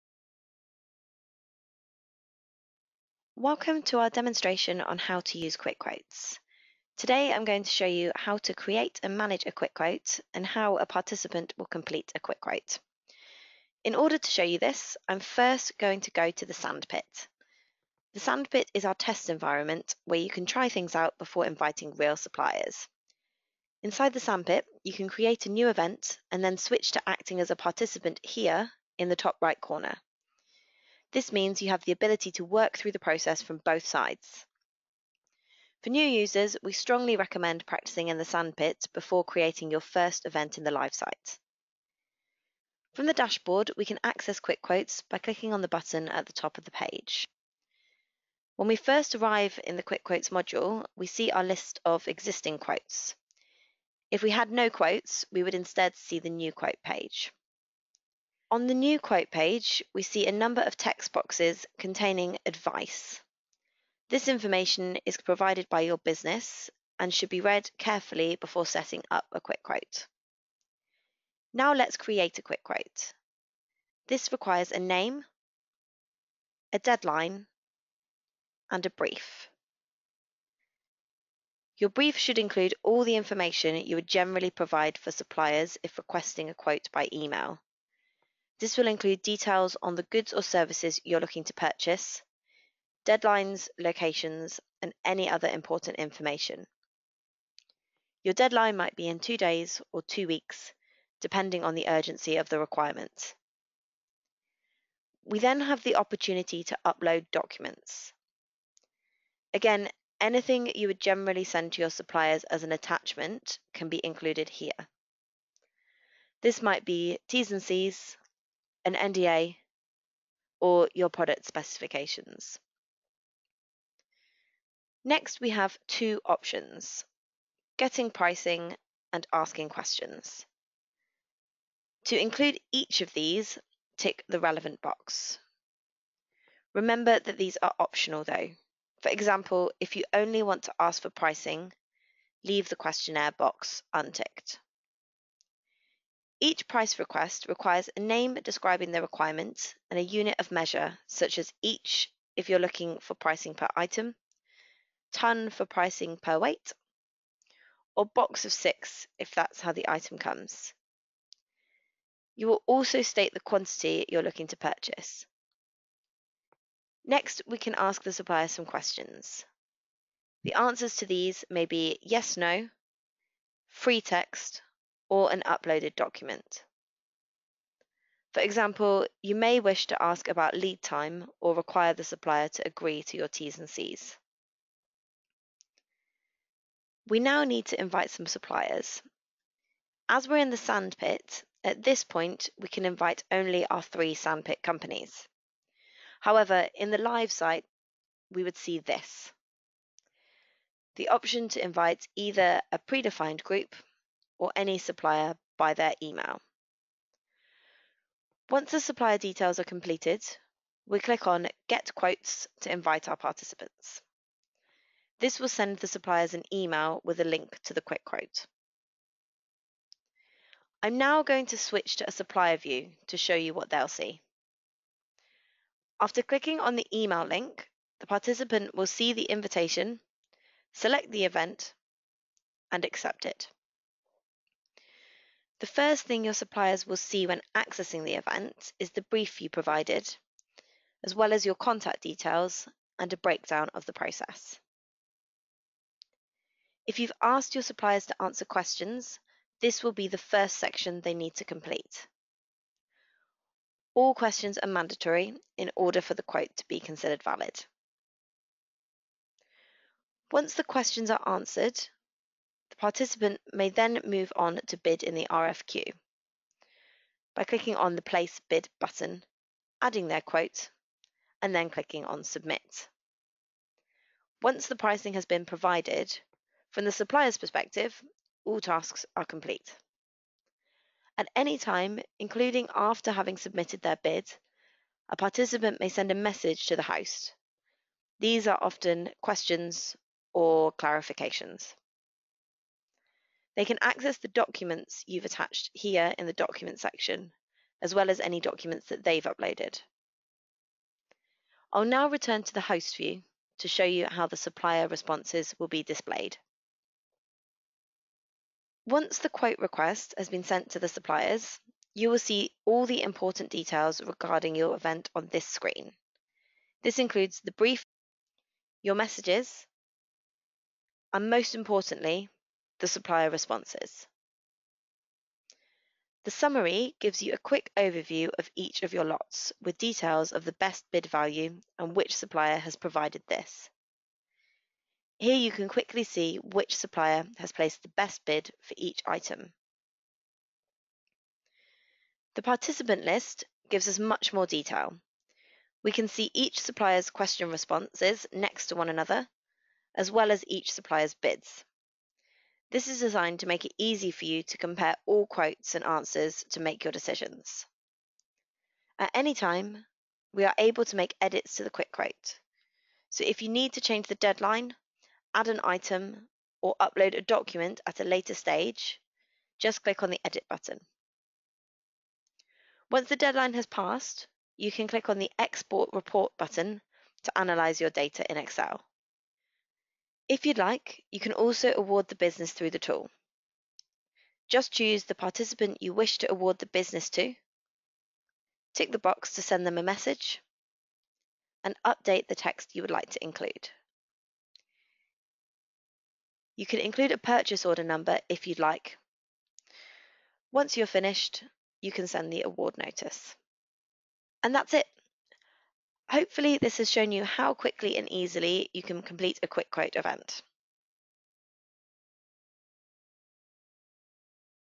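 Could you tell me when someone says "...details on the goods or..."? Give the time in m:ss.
1:29.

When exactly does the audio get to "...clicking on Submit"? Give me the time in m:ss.
4:31.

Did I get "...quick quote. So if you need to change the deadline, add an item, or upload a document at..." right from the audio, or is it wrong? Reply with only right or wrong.
right.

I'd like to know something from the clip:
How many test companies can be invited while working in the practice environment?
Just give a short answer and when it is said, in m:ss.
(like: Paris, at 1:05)
3, at 3:13.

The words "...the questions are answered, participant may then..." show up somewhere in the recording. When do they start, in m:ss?
4:20.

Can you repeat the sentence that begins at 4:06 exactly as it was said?
If you've asked your suppliers to answer questions, this will be the first section they need to complete.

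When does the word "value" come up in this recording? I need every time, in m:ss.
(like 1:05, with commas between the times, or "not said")
5:31.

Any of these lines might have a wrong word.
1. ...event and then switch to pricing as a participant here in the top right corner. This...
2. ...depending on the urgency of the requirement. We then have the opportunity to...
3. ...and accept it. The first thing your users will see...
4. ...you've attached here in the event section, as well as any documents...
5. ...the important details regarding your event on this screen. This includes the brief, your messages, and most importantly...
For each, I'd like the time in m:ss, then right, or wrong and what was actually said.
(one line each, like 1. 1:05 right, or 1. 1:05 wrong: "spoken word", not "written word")
1. 0:25 wrong: "acting", not "pricing"
2. 1:41 right
3. 3:52 wrong: "suppliers", not "users"
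4. 4:55 wrong: "document", not "event"
5. 5:12 right.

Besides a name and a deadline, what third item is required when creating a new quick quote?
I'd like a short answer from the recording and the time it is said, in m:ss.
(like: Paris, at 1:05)
a brief, at 1:18.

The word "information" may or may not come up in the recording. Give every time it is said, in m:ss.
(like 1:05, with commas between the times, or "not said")
1:04, 1:23, 1:35.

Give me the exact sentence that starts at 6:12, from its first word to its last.
Once the deadline has passed, you can click on the export report button to analyze your data in Excel.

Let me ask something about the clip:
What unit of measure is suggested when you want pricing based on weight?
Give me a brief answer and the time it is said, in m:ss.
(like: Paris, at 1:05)
ton, at 2:35.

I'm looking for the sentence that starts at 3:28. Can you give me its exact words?
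Once the supplier details are completed, we click on Get Quotes to invite our participants.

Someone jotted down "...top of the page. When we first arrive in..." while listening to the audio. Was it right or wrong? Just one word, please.
right.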